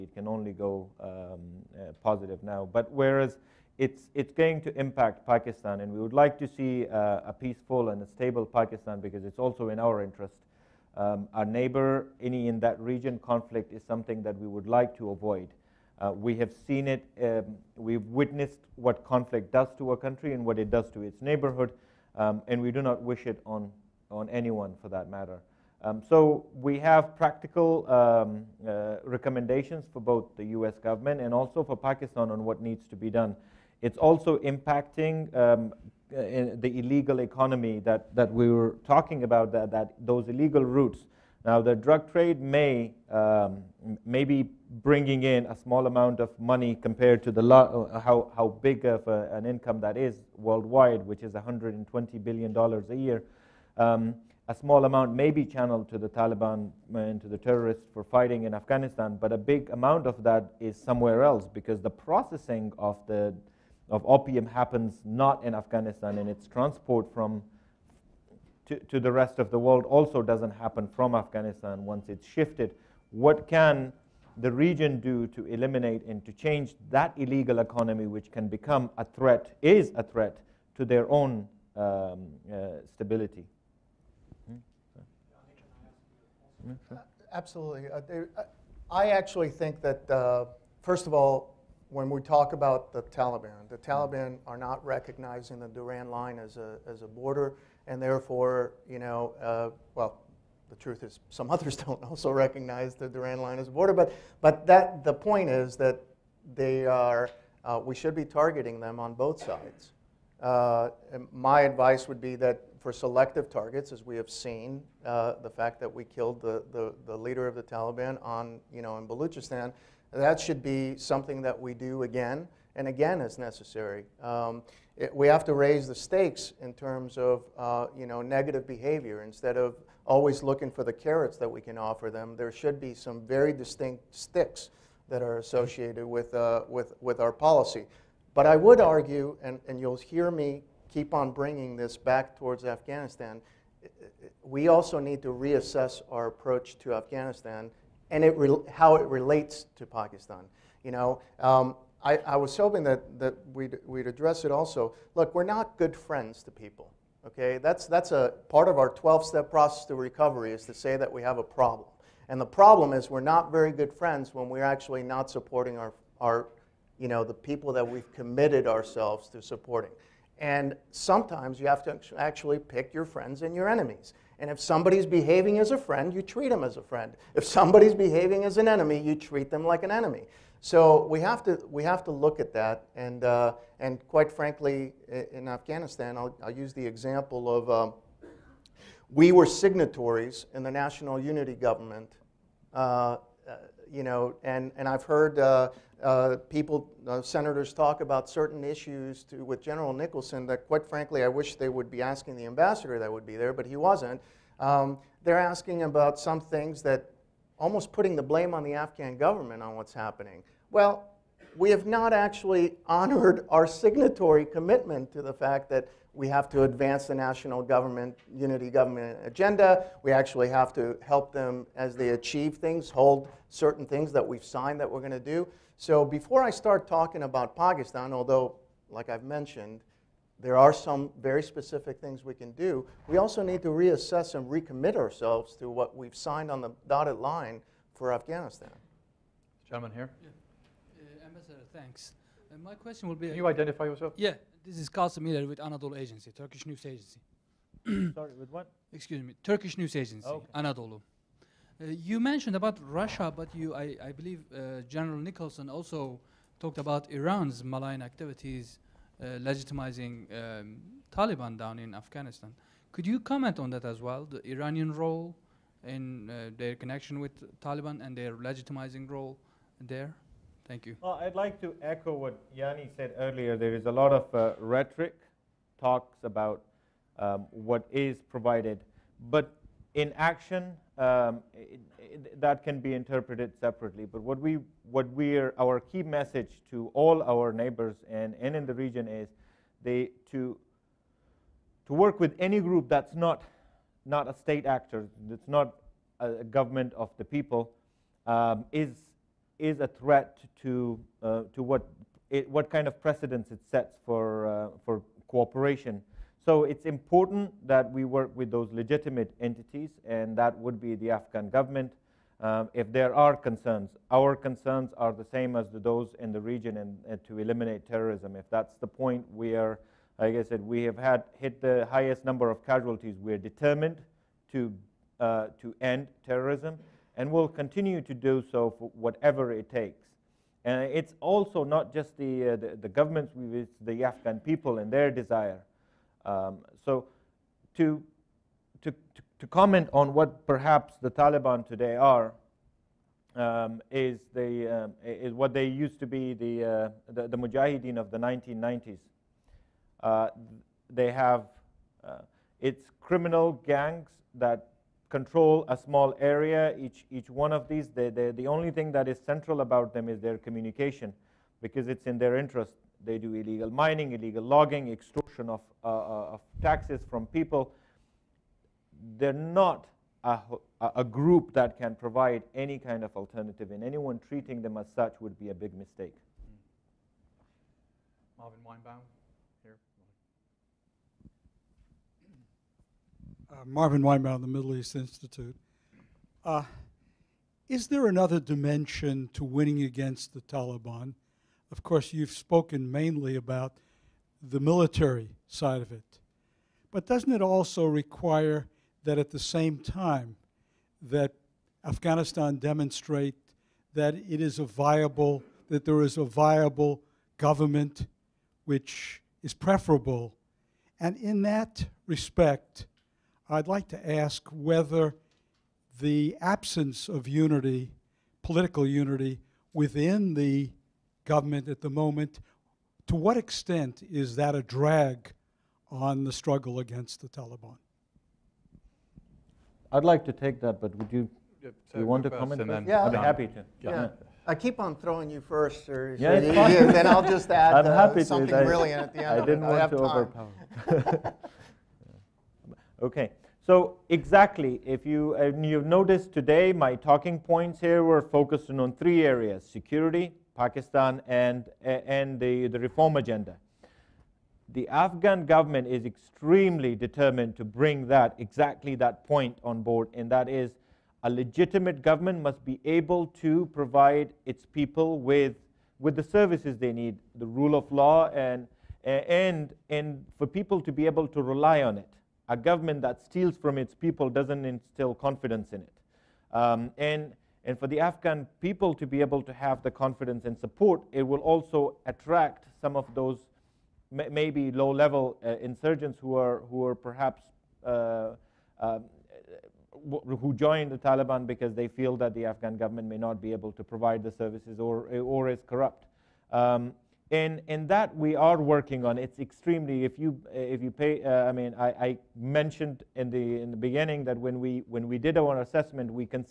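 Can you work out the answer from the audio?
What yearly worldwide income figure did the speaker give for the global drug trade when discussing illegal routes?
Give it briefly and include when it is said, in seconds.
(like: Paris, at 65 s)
$120 billion, at 51 s.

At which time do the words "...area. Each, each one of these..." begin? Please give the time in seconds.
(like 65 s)
356 s.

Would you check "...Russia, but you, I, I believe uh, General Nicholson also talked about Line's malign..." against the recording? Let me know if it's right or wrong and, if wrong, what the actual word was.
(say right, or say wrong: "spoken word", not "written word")
wrong: "Iran", not "Line".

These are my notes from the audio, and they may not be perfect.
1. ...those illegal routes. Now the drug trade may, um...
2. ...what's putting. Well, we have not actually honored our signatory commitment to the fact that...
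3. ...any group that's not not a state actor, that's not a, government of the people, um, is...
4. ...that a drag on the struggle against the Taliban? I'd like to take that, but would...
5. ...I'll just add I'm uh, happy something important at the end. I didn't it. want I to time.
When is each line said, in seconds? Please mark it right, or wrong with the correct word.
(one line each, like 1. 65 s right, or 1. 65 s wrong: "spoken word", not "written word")
1. 39 s right
2. 209 s wrong: "happening", not "putting"
3. 292 s right
4. 424 s right
5. 437 s wrong: "brilliant", not "important".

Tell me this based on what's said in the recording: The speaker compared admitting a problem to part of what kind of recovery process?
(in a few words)
12 step process.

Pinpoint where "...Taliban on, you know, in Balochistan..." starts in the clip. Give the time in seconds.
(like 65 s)
117 s.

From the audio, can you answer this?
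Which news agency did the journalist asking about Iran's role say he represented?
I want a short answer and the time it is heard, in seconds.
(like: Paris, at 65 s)
Anadolu Agency, at 245 s.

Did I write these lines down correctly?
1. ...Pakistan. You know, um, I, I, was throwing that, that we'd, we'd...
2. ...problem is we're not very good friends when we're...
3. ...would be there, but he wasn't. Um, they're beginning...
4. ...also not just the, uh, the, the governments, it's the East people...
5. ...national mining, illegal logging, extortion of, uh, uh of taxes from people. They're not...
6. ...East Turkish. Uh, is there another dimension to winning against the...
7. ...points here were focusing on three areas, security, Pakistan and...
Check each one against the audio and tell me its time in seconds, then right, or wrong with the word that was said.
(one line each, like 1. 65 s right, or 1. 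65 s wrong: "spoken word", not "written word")
1. 149 s wrong: "hoping", not "throwing"
2. 162 s right
3. 203 s wrong: "asking", not "beginning"
4. 331 s wrong: "Afghan", not "East"
5. 363 s wrong: "illegal", not "national"
6. 384 s wrong: "Institute", not "Turkish"
7. 447 s right.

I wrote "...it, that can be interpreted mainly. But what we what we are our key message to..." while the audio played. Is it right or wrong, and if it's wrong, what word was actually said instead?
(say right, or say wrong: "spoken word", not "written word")
wrong: "separately", not "mainly".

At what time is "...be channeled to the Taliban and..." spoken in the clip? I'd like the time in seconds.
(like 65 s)
55 s.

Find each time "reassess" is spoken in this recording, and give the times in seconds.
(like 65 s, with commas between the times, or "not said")
145 s, 233 s.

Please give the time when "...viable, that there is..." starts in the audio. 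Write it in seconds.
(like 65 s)
404 s.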